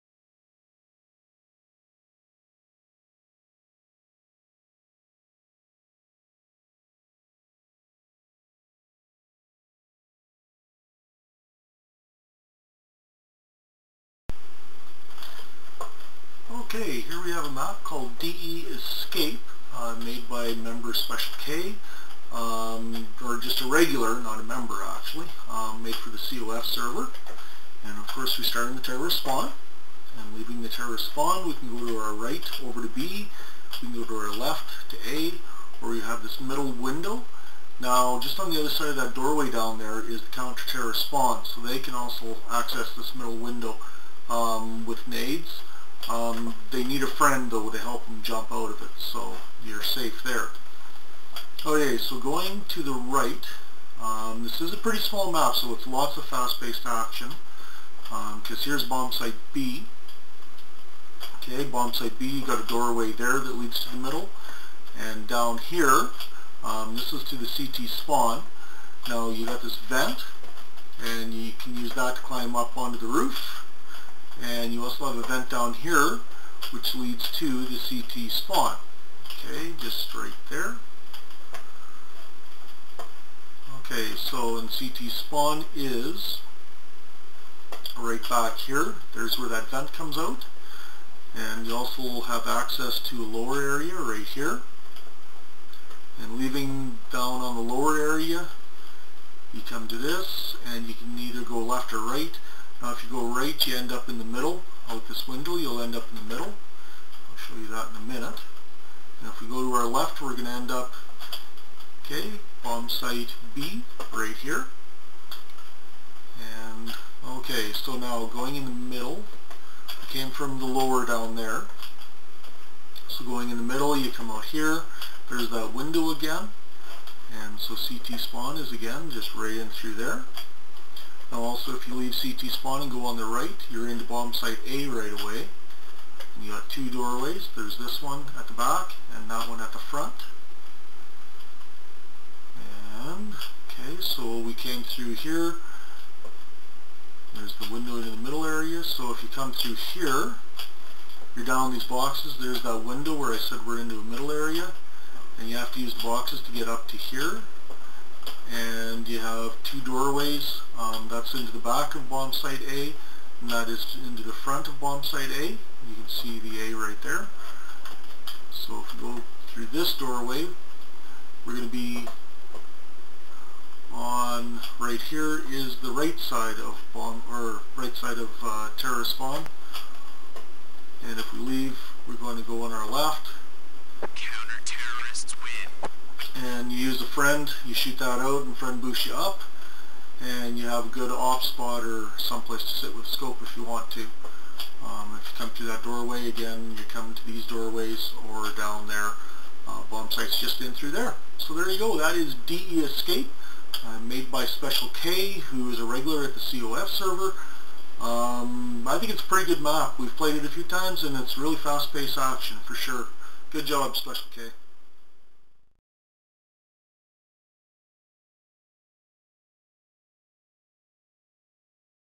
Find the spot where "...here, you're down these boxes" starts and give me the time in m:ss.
2:29.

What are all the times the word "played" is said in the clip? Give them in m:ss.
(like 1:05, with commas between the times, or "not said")
3:30.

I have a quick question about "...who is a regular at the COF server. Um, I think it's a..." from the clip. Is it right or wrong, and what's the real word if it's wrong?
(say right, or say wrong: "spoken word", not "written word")
right.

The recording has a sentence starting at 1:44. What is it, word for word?
Out this window, you'll end up in the middle.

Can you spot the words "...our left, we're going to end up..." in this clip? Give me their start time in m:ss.
1:49.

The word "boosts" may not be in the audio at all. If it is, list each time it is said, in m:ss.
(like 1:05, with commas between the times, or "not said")
3:08.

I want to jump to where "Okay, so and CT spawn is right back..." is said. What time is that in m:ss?
1:23.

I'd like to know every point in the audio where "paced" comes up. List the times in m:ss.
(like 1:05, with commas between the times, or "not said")
0:56, 3:31.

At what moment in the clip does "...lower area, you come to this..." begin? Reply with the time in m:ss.
1:37.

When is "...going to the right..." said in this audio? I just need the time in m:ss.
0:52.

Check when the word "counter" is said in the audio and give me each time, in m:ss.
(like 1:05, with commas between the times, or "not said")
0:40.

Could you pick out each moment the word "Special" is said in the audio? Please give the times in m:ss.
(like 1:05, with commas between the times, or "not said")
0:20, 3:24, 3:33.